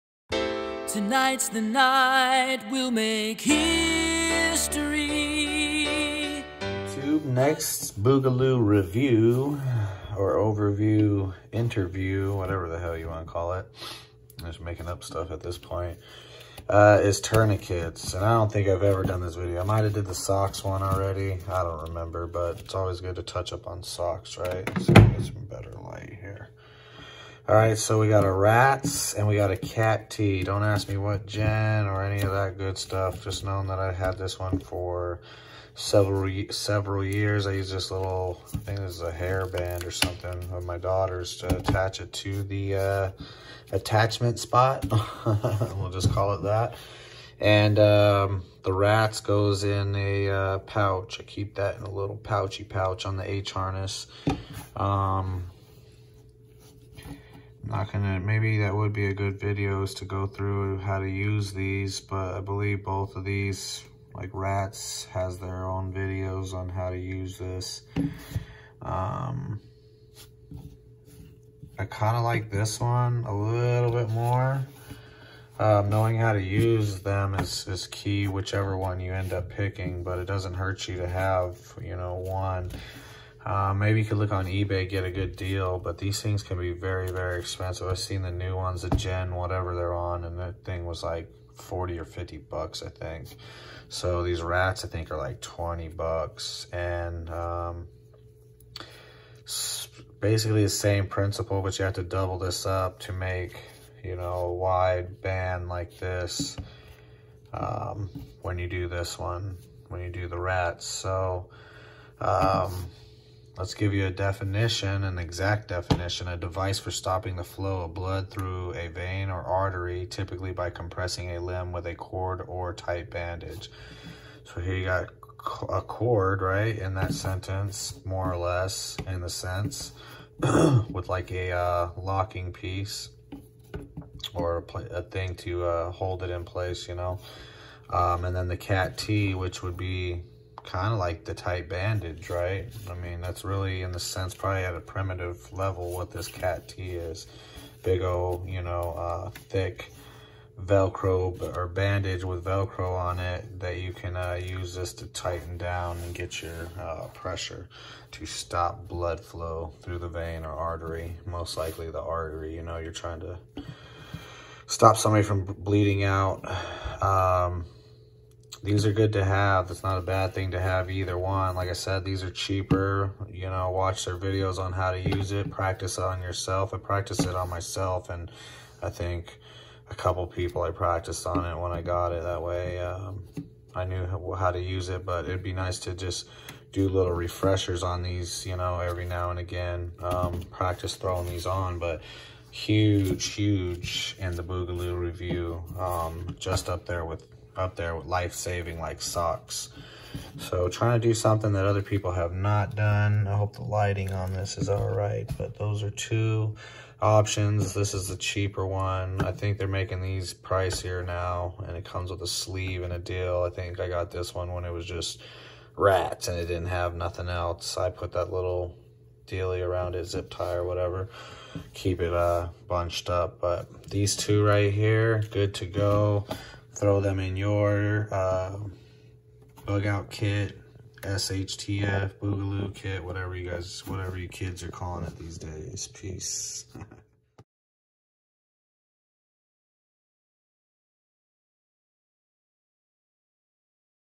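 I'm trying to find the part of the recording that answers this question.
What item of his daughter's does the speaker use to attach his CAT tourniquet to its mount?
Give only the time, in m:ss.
0:39.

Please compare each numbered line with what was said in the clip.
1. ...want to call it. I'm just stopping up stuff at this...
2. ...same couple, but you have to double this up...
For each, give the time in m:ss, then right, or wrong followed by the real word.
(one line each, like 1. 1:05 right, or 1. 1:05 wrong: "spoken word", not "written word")
1. 0:13 wrong: "making", not "stopping"
2. 1:40 wrong: "principle", not "couple".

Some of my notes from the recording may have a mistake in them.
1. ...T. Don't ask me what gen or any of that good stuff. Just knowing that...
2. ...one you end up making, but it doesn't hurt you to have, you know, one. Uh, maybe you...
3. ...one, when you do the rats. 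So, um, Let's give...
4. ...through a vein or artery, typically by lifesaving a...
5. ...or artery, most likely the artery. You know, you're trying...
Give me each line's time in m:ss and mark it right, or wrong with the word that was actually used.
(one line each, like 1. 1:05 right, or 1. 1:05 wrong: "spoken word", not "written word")
1. 0:30 right
2. 1:18 wrong: "picking", not "making"
3. 1:49 right
4. 1:58 wrong: "compressing", not "lifesaving"
5. 2:40 right.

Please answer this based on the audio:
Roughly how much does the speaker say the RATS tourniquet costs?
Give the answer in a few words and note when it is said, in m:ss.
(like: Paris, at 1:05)
$20, at 1:35.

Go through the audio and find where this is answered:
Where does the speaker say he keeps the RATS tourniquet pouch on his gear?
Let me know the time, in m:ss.
0:53.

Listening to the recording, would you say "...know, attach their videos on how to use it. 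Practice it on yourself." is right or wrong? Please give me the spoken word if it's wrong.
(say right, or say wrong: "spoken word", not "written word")
wrong: "watch", not "attach".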